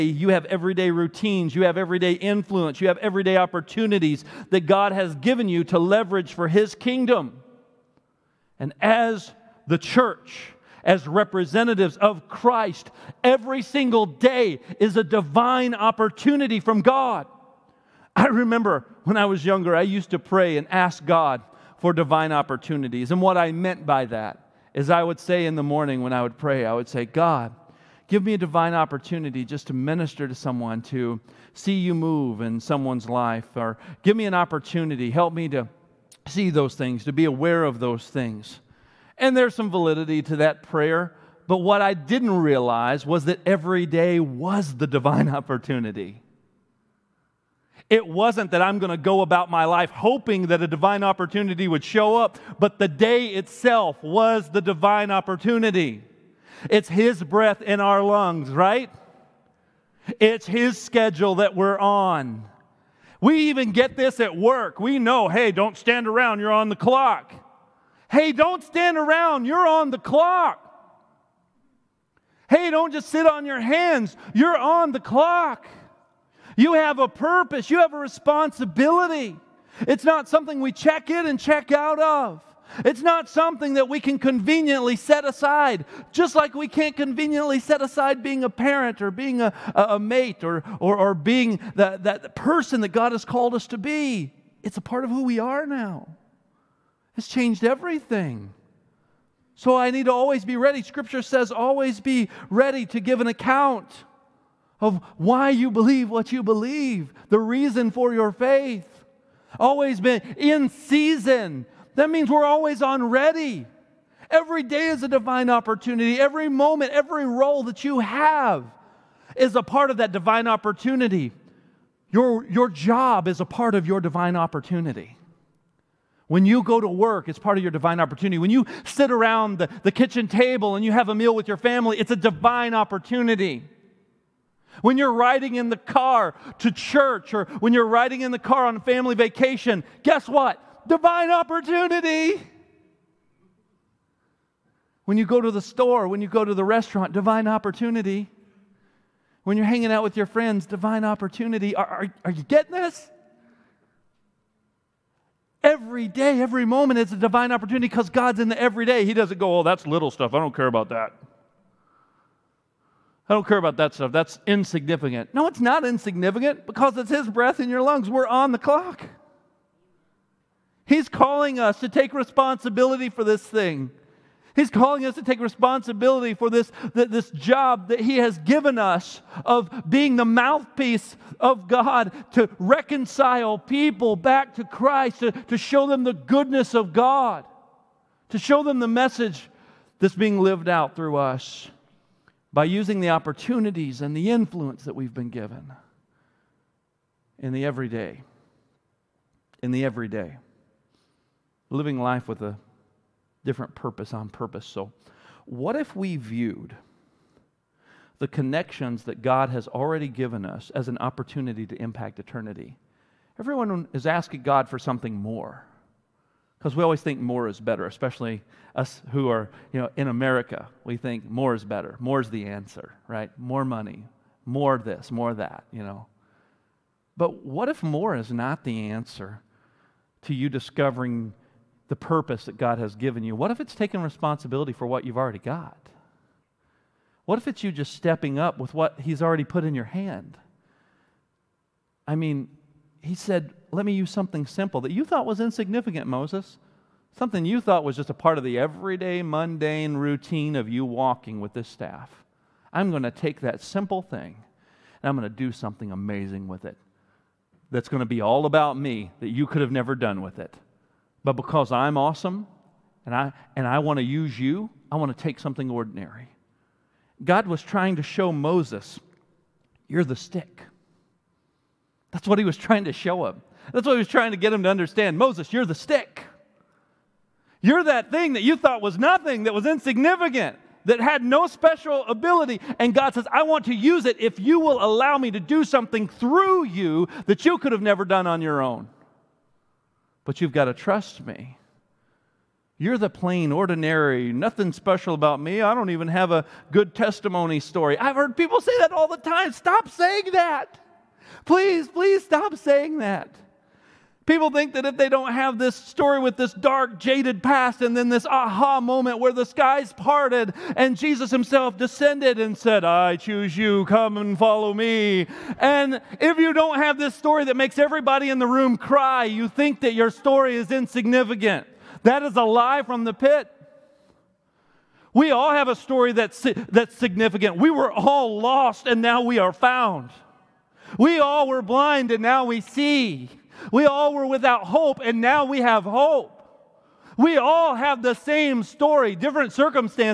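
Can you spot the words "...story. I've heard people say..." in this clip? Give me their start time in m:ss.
4:57.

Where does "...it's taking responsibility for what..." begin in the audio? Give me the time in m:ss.
3:53.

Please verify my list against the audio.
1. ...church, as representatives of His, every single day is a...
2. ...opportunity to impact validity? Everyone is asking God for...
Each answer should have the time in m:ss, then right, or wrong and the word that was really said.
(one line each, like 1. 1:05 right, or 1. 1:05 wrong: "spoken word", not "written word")
1. 0:09 wrong: "Christ", not "His"
2. 3:30 wrong: "eternity", not "validity".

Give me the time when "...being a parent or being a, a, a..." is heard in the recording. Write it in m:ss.
1:28.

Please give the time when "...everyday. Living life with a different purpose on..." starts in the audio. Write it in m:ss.
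3:19.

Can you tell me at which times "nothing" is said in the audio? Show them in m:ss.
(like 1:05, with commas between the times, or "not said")
4:38, 4:54.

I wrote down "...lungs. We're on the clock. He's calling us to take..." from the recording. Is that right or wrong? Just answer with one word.
right.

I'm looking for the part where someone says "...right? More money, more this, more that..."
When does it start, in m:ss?
3:43.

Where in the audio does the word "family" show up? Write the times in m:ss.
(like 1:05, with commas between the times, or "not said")
2:11, 2:18.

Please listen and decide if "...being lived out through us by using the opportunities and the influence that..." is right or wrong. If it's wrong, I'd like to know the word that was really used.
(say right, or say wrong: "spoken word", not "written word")
right.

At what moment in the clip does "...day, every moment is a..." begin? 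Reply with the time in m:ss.
2:36.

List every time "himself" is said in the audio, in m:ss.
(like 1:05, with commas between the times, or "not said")
5:11.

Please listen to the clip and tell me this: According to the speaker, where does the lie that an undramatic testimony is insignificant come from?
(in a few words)
the pit.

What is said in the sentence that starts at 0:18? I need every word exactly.
I remember when I was younger, I used to pray and ask God for divine opportunities.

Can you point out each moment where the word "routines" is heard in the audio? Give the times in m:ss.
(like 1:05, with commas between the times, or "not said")
0:00, 4:09.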